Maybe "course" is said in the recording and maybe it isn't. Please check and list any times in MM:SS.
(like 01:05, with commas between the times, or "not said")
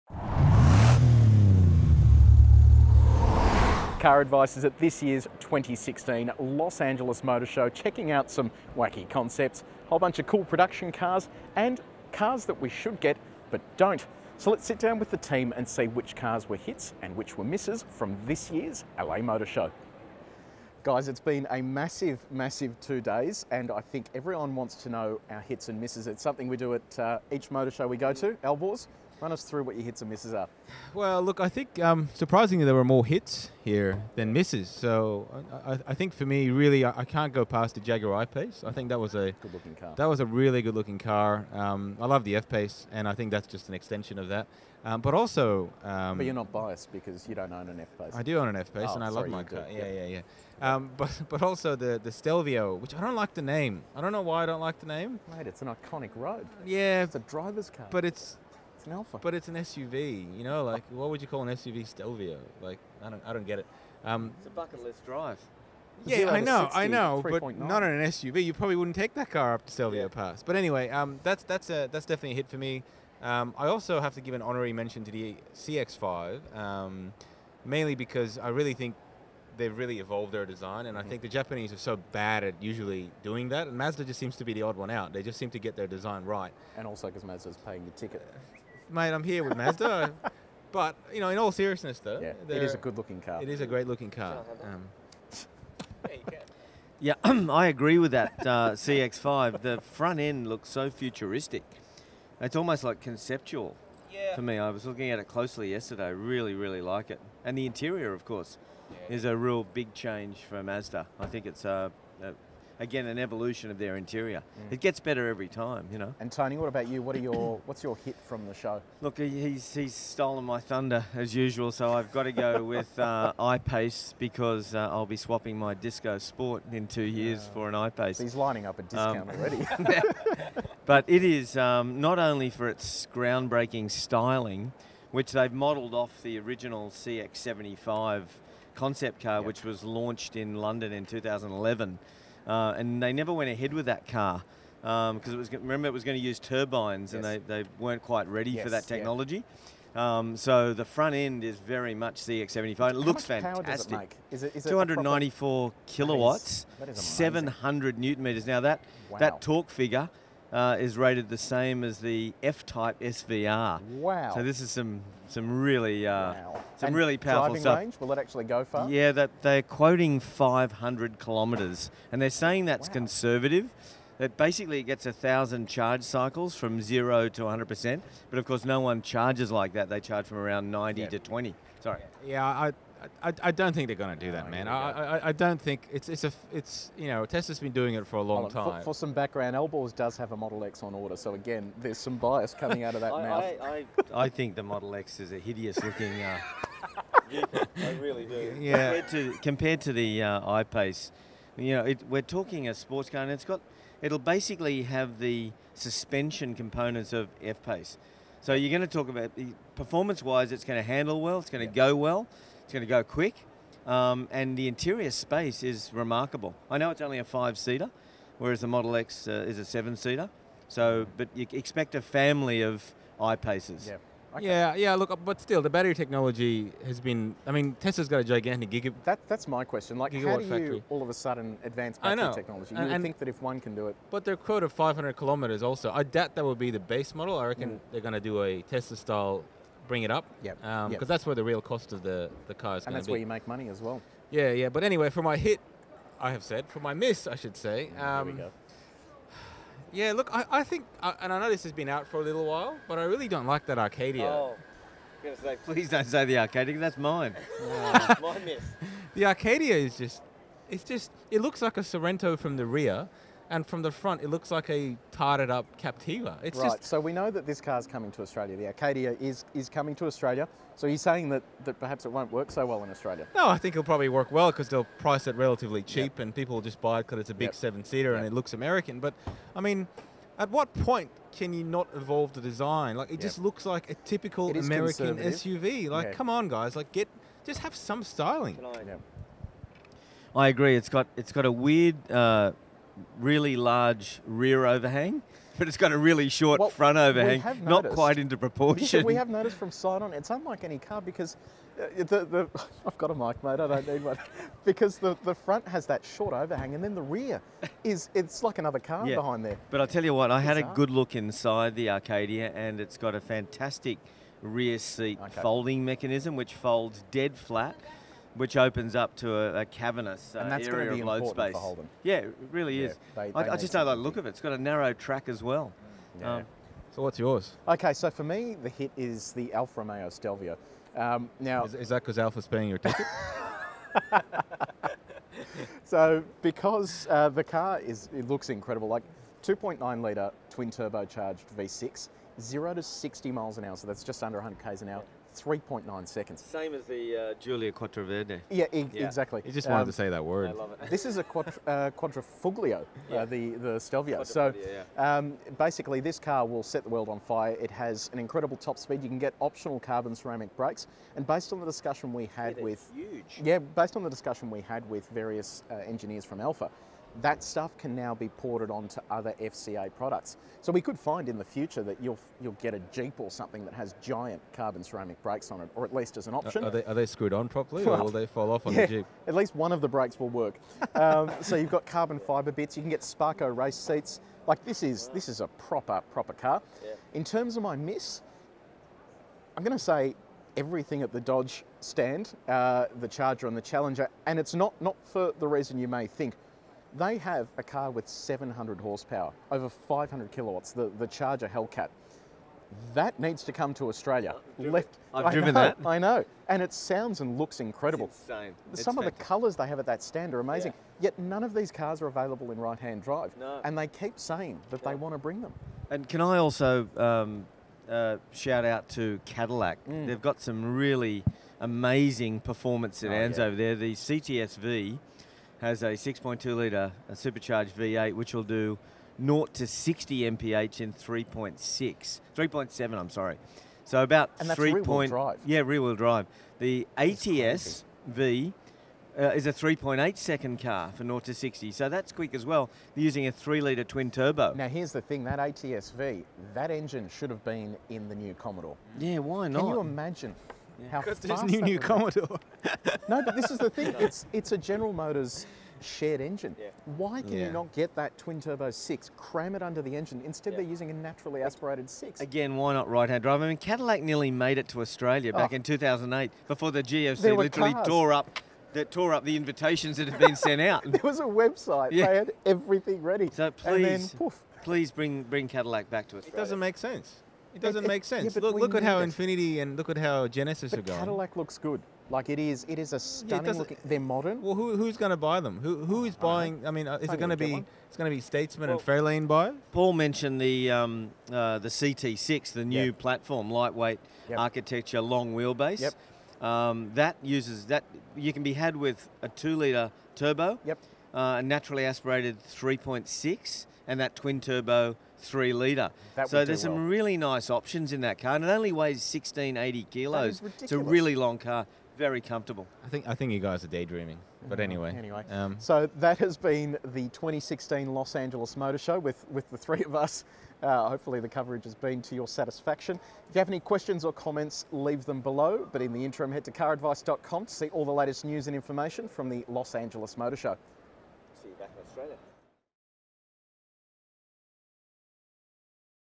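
01:48, 02:58.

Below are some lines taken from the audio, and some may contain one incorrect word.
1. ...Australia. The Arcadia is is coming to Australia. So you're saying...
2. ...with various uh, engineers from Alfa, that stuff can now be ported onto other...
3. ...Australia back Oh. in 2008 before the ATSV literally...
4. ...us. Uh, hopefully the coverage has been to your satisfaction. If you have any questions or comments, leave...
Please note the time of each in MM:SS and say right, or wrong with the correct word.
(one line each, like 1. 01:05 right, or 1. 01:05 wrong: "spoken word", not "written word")
1. 04:28 right
2. 06:04 right
3. 07:44 wrong: "GFC", not "ATSV"
4. 08:39 right.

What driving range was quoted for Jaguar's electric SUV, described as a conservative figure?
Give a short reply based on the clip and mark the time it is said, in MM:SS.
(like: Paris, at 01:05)
500 kilometres, at 02:50.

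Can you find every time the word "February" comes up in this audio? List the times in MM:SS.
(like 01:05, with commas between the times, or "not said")
not said.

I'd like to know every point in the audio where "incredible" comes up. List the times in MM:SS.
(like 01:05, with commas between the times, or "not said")
05:38, 05:58, 06:47.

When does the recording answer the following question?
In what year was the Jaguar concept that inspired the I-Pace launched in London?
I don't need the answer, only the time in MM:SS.
02:21.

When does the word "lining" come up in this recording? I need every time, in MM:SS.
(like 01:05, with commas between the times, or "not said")
02:08.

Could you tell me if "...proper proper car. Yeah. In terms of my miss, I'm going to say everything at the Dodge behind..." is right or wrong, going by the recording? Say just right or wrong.
wrong.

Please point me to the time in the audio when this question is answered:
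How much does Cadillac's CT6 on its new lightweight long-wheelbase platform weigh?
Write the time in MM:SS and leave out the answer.
08:28.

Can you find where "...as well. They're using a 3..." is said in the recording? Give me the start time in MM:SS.
07:22.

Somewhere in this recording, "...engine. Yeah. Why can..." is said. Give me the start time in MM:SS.
07:36.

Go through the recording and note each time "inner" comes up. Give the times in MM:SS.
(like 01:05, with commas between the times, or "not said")
not said.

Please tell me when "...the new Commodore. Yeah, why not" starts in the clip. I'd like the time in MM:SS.
07:28.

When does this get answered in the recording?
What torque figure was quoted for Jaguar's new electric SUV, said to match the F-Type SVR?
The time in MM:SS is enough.
02:36.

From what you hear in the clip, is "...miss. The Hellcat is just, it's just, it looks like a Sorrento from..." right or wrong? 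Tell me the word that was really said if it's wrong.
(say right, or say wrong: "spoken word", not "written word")
wrong: "Arcadia", not "Hellcat".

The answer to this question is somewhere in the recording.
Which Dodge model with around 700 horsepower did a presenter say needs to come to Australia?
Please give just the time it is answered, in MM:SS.
06:41.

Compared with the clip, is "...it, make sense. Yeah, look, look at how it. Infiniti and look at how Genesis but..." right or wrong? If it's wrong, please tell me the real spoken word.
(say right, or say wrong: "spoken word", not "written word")
right.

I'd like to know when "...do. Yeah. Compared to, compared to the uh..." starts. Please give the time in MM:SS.
03:18.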